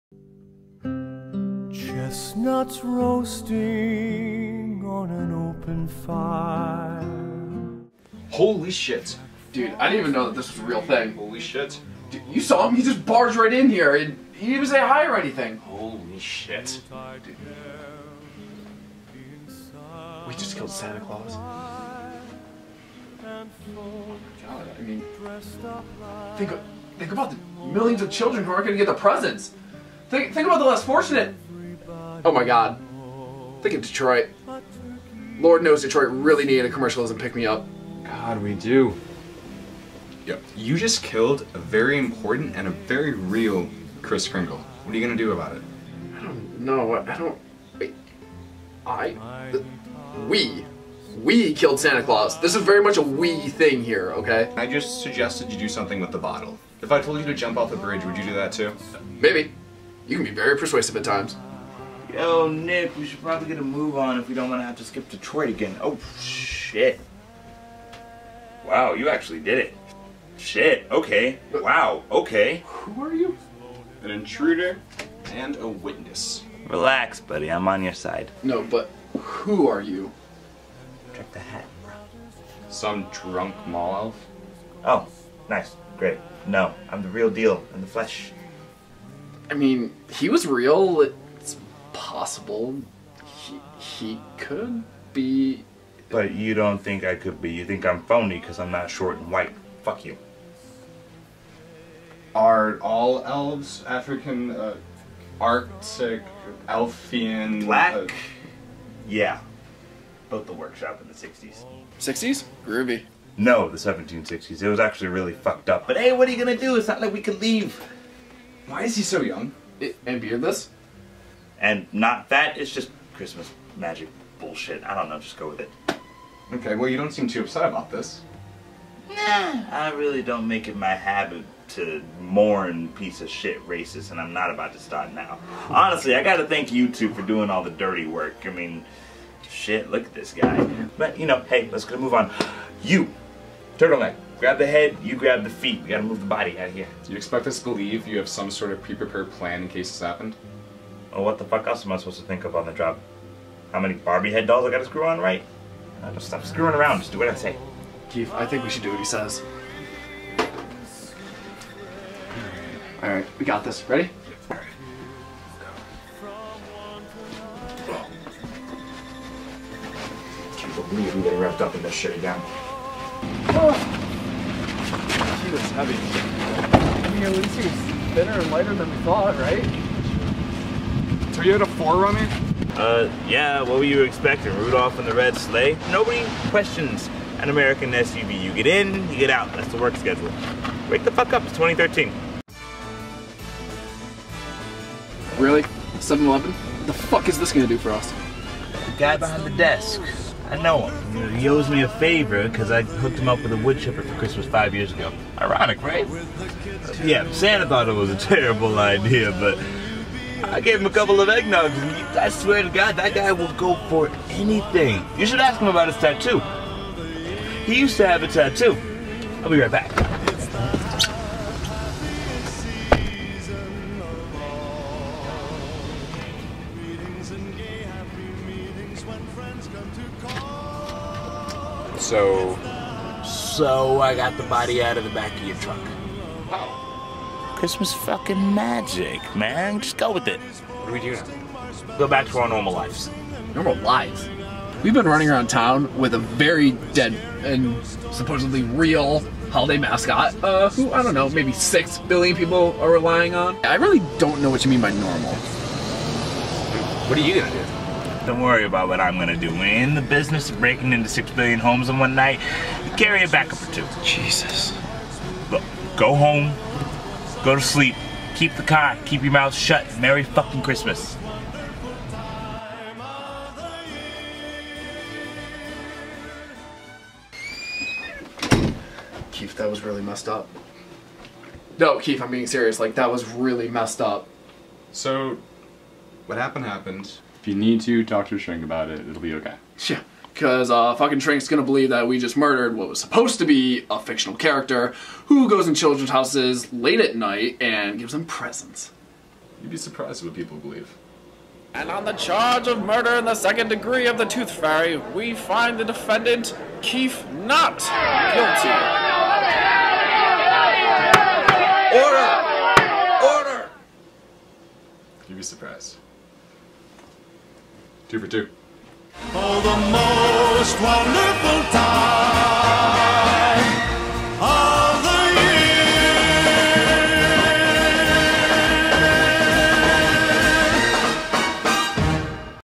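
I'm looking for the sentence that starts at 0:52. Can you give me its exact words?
This is very much a we thing here, okay?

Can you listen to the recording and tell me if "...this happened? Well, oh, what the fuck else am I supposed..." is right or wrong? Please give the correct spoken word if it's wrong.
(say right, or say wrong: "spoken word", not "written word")
right.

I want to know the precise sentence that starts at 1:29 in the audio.
I mean, he was real possible.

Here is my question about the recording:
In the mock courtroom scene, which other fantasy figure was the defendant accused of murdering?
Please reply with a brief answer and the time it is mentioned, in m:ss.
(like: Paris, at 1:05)
The Tooth Fairy, at 5:04.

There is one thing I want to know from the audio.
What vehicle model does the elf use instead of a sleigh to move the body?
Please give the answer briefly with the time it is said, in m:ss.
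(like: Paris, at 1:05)
Toyota 4Runner, at 3:01.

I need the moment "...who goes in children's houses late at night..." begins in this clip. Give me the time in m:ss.
4:55.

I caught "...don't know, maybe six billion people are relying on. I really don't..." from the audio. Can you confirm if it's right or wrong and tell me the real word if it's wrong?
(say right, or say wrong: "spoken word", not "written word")
right.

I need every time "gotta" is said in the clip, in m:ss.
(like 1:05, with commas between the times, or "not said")
2:16, 2:25, 2:34.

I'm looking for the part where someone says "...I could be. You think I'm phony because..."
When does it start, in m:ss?
1:37.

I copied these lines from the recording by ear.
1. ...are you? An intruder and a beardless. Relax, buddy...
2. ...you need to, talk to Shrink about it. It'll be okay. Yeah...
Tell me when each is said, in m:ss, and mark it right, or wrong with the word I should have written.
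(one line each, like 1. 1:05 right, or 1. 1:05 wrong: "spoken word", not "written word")
1. 1:13 wrong: "witness", not "beardless"
2. 4:47 right.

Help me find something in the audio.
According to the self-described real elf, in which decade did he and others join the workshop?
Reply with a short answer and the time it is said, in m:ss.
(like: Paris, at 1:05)
1760s, at 1:53.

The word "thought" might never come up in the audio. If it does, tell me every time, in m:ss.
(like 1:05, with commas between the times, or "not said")
2:59, 3:27.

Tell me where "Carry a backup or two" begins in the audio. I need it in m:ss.
4:22.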